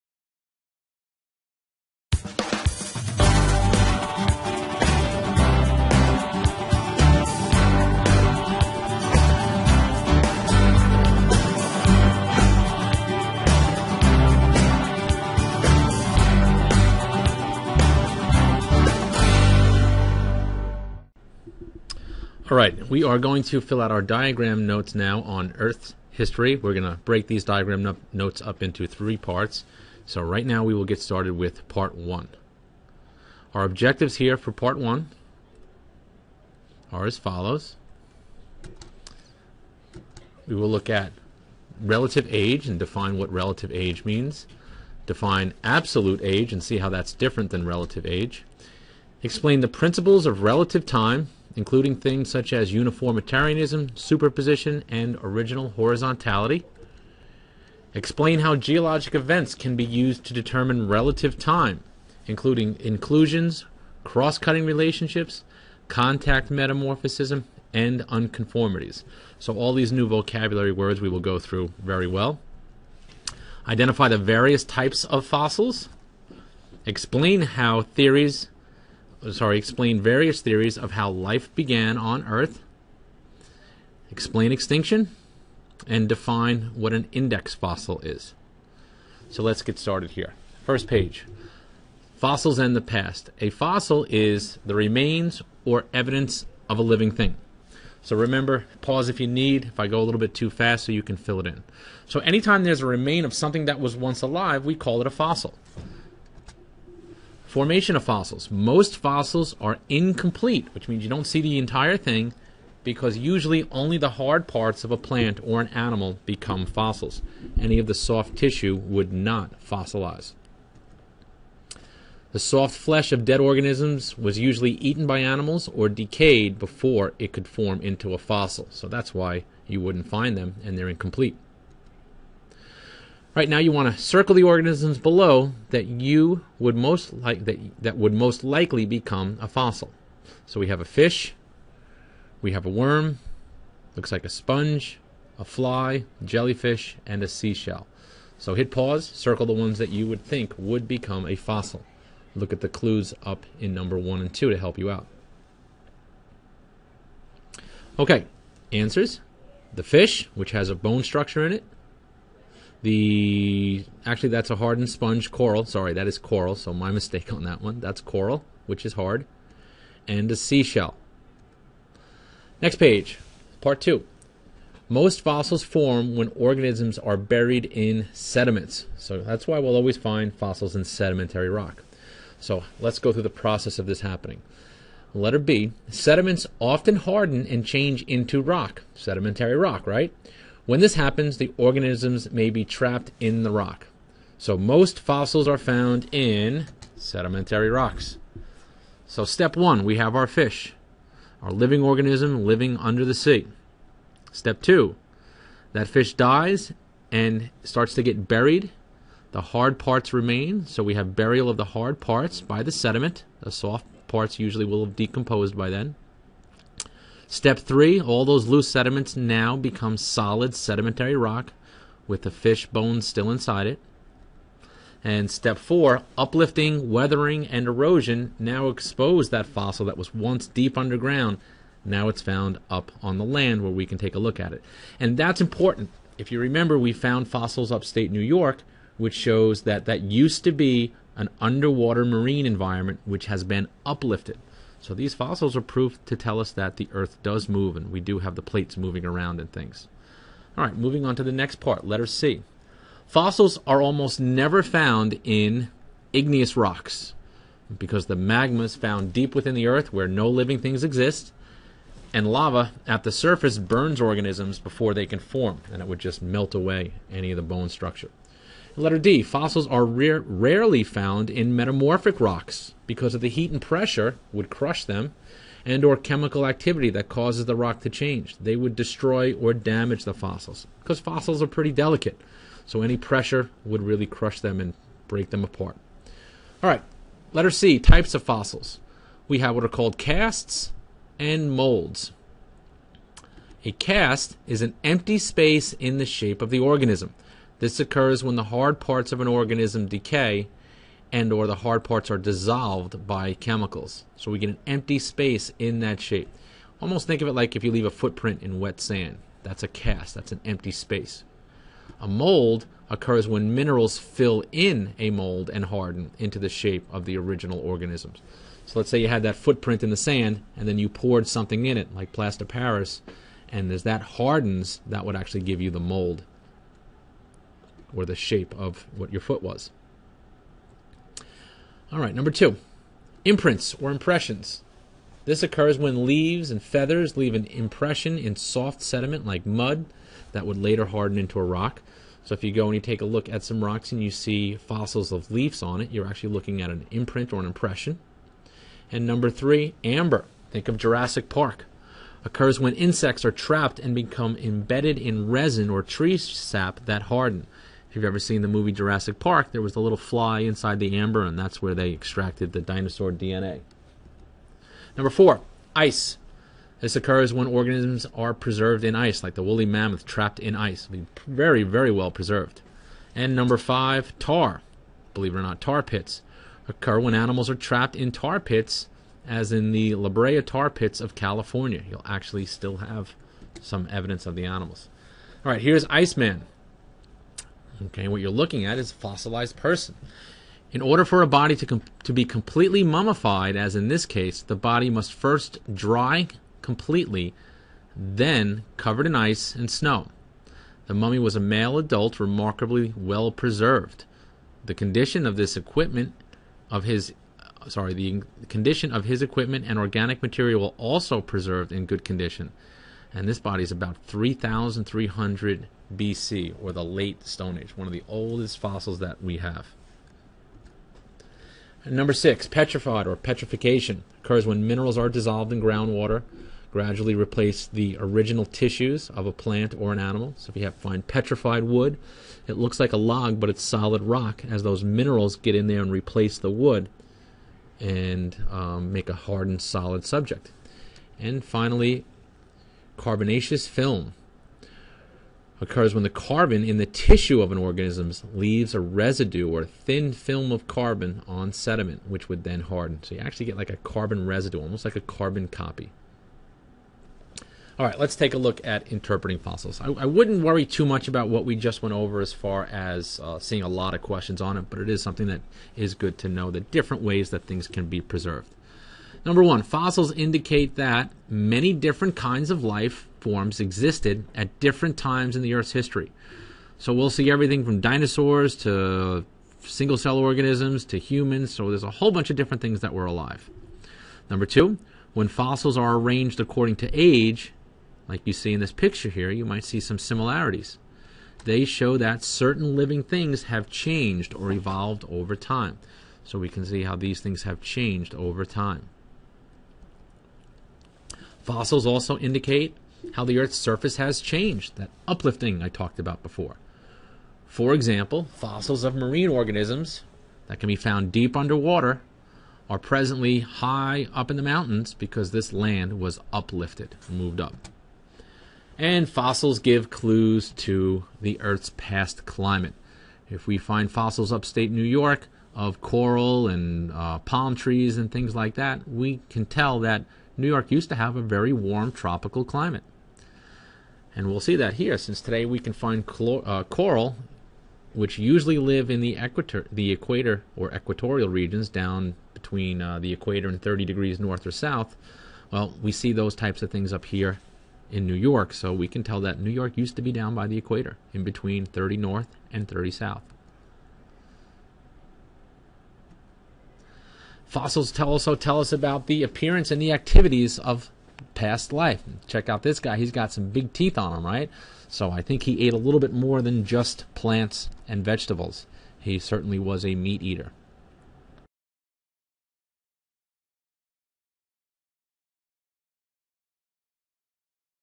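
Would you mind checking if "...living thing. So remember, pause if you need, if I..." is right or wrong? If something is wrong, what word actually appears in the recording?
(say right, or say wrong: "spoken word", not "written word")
right.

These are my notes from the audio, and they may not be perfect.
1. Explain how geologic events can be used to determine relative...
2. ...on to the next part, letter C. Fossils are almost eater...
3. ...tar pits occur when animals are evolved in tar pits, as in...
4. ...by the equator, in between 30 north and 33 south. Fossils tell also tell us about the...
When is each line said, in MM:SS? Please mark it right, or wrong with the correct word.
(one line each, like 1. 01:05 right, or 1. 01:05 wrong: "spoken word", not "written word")
1. 00:57 right
2. 04:11 wrong: "never", not "eater"
3. 06:15 wrong: "trapped", not "evolved"
4. 09:10 wrong: "30", not "33".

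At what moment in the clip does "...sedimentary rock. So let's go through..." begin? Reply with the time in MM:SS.
03:00.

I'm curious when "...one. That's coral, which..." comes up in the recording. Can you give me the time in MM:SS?
02:47.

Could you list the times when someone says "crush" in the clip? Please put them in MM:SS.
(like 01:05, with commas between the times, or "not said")
04:34, 04:44.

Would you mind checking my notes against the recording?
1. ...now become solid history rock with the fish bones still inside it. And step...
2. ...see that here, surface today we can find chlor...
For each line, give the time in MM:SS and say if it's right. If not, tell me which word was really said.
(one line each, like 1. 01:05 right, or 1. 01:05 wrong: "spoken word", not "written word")
1. 03:39 wrong: "sedimentary", not "history"
2. 08:54 wrong: "since", not "surface".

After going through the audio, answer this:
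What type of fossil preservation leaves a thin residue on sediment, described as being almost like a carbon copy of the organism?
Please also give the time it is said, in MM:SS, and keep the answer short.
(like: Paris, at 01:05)
Carbonaceous film, at 07:22.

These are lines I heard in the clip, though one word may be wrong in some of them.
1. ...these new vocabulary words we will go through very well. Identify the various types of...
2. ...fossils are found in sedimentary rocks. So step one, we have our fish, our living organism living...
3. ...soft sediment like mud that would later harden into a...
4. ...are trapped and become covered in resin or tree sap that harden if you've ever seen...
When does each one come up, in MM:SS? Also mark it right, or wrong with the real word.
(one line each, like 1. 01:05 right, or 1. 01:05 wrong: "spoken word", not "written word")
1. 01:09 right
2. 03:15 right
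3. 05:38 right
4. 05:53 wrong: "embedded", not "covered".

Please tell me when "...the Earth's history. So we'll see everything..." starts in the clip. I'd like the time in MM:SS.
07:55.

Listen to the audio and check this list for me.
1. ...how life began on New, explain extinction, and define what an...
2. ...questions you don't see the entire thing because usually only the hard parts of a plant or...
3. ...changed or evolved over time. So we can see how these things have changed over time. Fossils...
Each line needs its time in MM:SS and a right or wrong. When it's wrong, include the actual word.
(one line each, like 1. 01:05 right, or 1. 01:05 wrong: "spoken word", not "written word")
1. 01:20 wrong: "Earth", not "New"
2. 01:50 wrong: "means", not "questions"
3. 08:13 right.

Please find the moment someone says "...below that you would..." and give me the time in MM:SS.
02:14.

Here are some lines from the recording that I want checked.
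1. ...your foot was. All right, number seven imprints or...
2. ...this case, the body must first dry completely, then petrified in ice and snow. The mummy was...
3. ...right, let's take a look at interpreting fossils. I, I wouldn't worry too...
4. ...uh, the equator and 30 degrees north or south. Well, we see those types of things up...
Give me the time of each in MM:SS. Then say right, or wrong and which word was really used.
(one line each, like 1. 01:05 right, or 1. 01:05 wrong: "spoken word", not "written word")
1. 05:29 wrong: "two", not "seven"
2. 06:33 wrong: "covered", not "petrified"
3. 07:37 right
4. 09:02 right.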